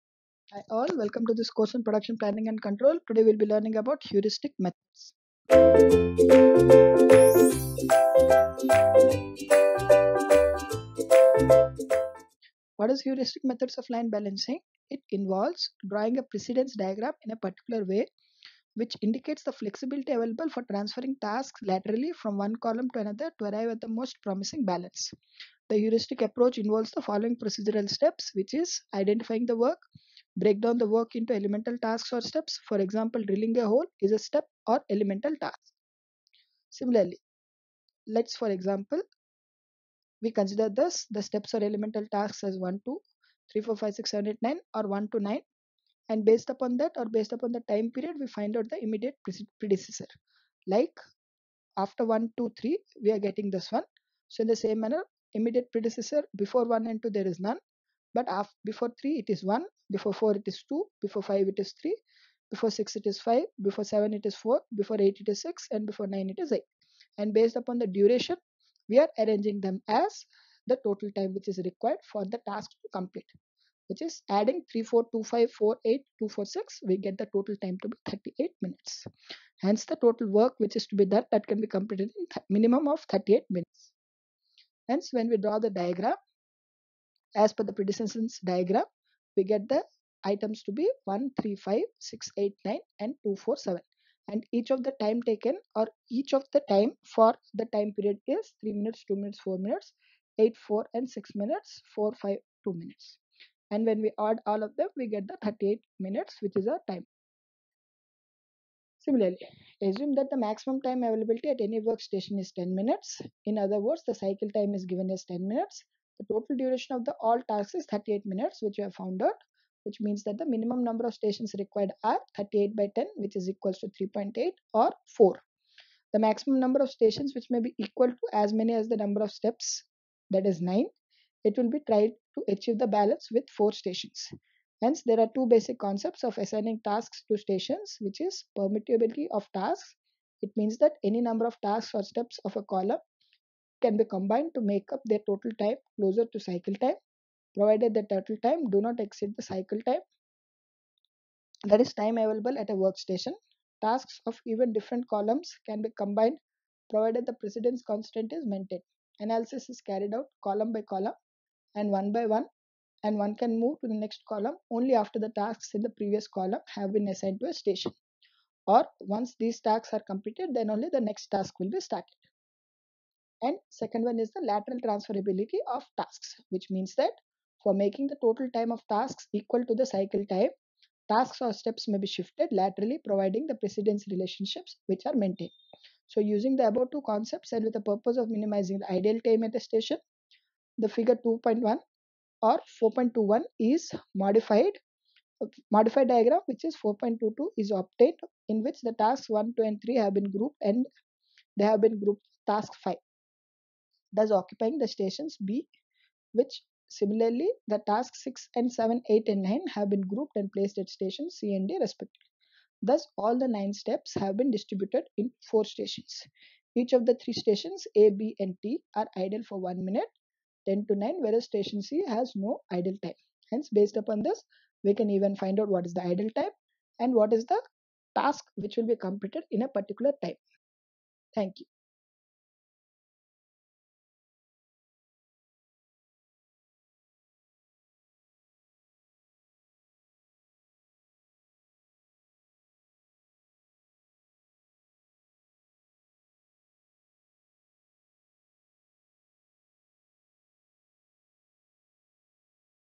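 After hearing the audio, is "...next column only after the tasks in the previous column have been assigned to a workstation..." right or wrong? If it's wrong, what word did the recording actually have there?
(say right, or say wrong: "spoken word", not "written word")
wrong: "station", not "workstation".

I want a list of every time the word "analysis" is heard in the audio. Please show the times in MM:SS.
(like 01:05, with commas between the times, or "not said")
02:39.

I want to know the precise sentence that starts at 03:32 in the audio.
Thus, all the nine steps have been distributed in four stations.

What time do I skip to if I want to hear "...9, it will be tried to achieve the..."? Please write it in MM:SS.
02:10.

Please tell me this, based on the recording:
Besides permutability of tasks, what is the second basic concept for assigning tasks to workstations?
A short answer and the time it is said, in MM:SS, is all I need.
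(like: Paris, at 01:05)
lateral transferability of tasks, at 02:54.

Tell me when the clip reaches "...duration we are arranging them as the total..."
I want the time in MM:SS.
01:07.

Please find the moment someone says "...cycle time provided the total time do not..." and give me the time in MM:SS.
02:26.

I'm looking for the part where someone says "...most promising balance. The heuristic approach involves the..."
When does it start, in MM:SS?
00:23.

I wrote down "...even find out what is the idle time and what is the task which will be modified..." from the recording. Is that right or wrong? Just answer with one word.
wrong.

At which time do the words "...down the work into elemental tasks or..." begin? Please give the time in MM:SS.
00:30.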